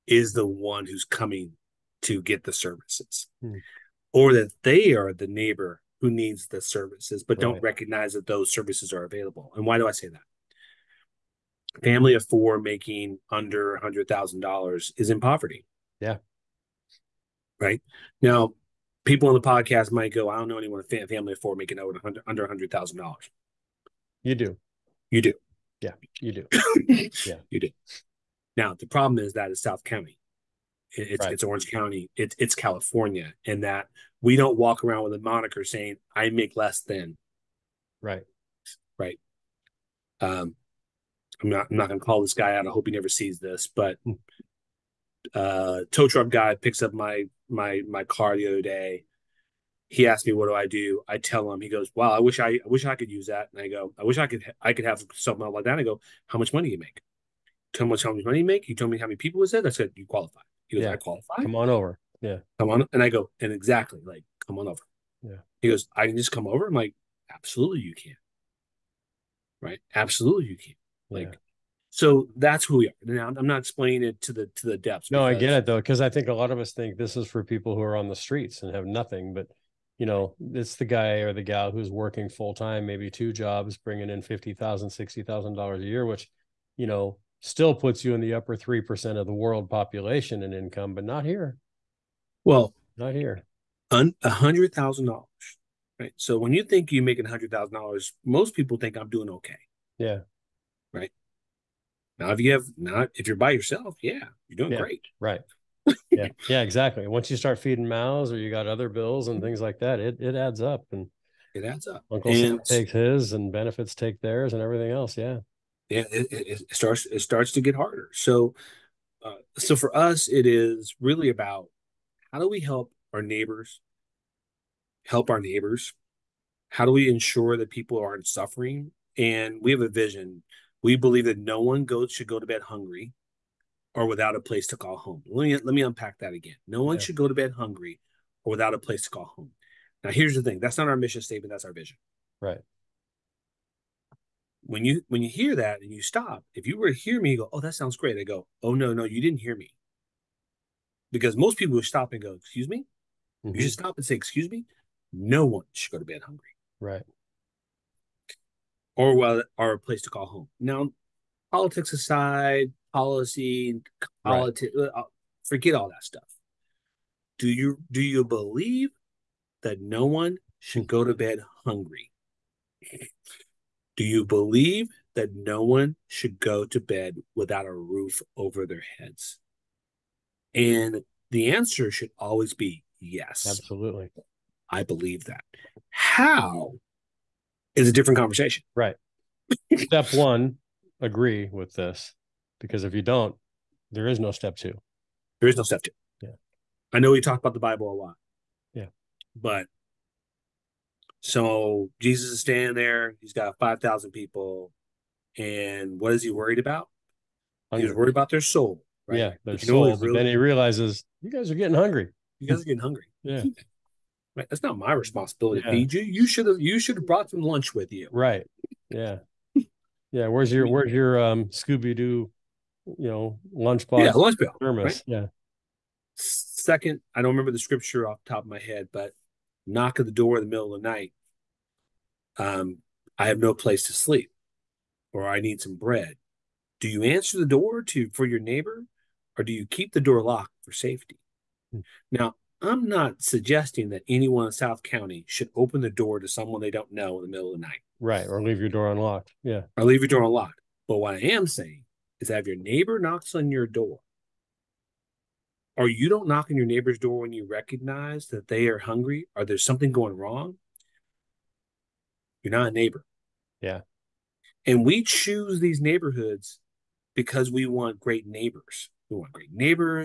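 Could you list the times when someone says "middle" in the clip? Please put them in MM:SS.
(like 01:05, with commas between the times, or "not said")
03:50, 04:07.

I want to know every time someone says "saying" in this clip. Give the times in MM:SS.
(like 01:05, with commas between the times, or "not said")
00:35, 04:11.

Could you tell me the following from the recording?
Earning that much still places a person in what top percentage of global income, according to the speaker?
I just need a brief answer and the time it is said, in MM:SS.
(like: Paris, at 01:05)
Upper 3 percent, at 01:28.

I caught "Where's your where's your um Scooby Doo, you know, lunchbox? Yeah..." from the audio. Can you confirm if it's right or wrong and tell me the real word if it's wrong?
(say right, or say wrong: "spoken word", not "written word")
right.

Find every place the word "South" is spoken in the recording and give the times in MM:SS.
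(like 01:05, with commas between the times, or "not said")
00:29, 04:04.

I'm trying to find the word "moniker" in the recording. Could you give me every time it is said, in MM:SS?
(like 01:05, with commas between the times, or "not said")
00:35.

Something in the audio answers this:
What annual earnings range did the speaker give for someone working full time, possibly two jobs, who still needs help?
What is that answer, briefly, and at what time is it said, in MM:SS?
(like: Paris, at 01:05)
$50,000 to $60,000, at 01:24.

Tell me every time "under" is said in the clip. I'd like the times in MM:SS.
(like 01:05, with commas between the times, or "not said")
00:13, 00:22.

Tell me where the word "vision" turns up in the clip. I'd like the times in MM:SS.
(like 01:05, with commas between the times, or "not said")
02:09, 02:21.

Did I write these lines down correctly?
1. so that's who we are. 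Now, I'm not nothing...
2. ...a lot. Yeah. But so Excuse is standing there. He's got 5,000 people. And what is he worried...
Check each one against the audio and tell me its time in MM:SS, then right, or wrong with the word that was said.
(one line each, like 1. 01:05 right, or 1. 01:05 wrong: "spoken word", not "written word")
1. 01:11 wrong: "explaining", not "nothing"
2. 03:17 wrong: "Jesus", not "Excuse".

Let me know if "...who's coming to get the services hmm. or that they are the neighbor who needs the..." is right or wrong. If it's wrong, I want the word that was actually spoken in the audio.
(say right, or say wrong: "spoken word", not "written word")
right.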